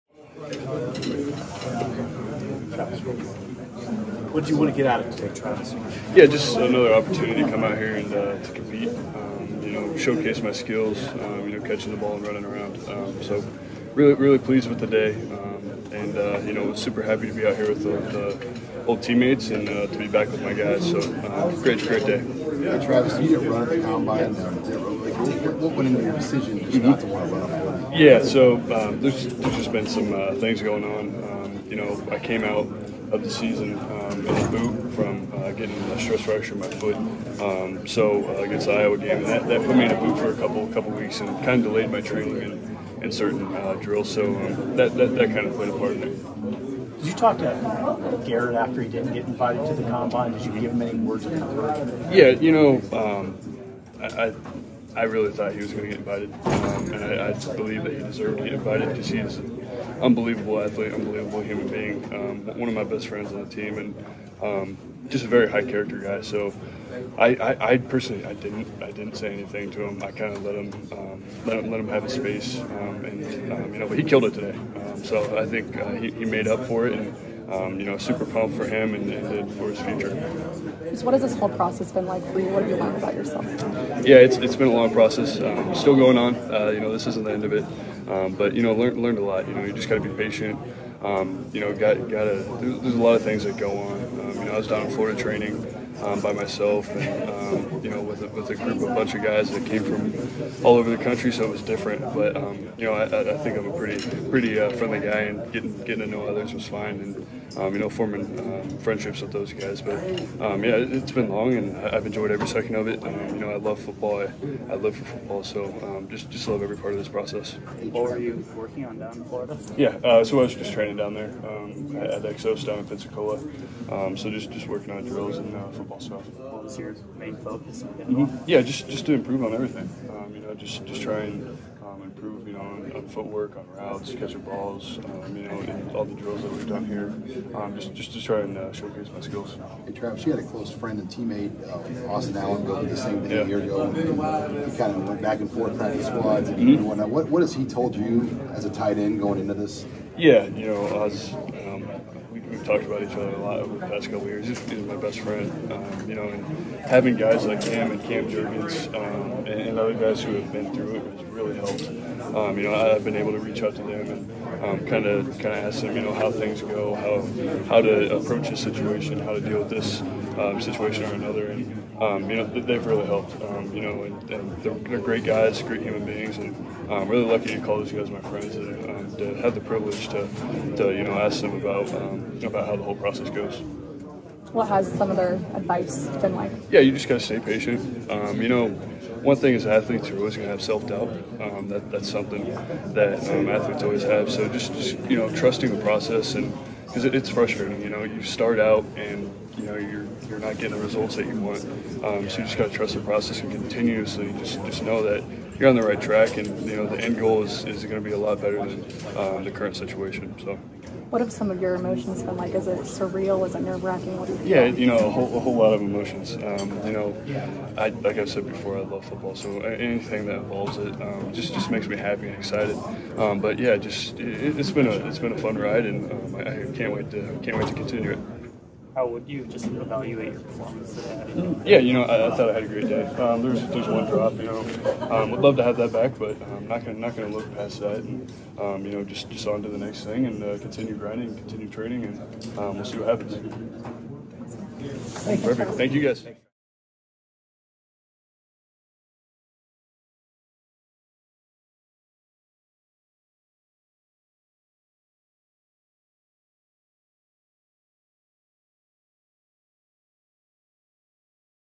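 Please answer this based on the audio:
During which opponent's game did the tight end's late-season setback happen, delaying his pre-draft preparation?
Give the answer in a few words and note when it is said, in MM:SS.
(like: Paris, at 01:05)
Iowa, at 00:38.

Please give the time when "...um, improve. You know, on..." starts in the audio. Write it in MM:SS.
02:11.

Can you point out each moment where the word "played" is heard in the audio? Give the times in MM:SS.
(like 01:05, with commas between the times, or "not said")
00:45.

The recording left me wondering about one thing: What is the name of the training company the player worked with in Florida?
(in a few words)
Exos.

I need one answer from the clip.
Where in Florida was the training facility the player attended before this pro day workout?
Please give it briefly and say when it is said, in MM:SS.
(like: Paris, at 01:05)
Pensacola, at 02:02.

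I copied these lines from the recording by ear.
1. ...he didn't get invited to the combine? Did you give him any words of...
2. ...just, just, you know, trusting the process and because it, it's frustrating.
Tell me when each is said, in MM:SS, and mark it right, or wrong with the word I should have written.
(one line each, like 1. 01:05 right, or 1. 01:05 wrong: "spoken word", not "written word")
1. 00:48 right
2. 03:14 right.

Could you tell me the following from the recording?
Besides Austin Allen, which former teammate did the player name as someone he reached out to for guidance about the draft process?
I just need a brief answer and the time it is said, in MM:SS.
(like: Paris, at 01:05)
Cam Jurgens, at 02:38.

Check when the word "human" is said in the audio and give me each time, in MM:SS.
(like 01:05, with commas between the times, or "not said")
01:01, 02:55.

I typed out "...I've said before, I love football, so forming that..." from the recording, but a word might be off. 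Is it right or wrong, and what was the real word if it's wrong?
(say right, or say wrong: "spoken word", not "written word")
wrong: "anything", not "forming".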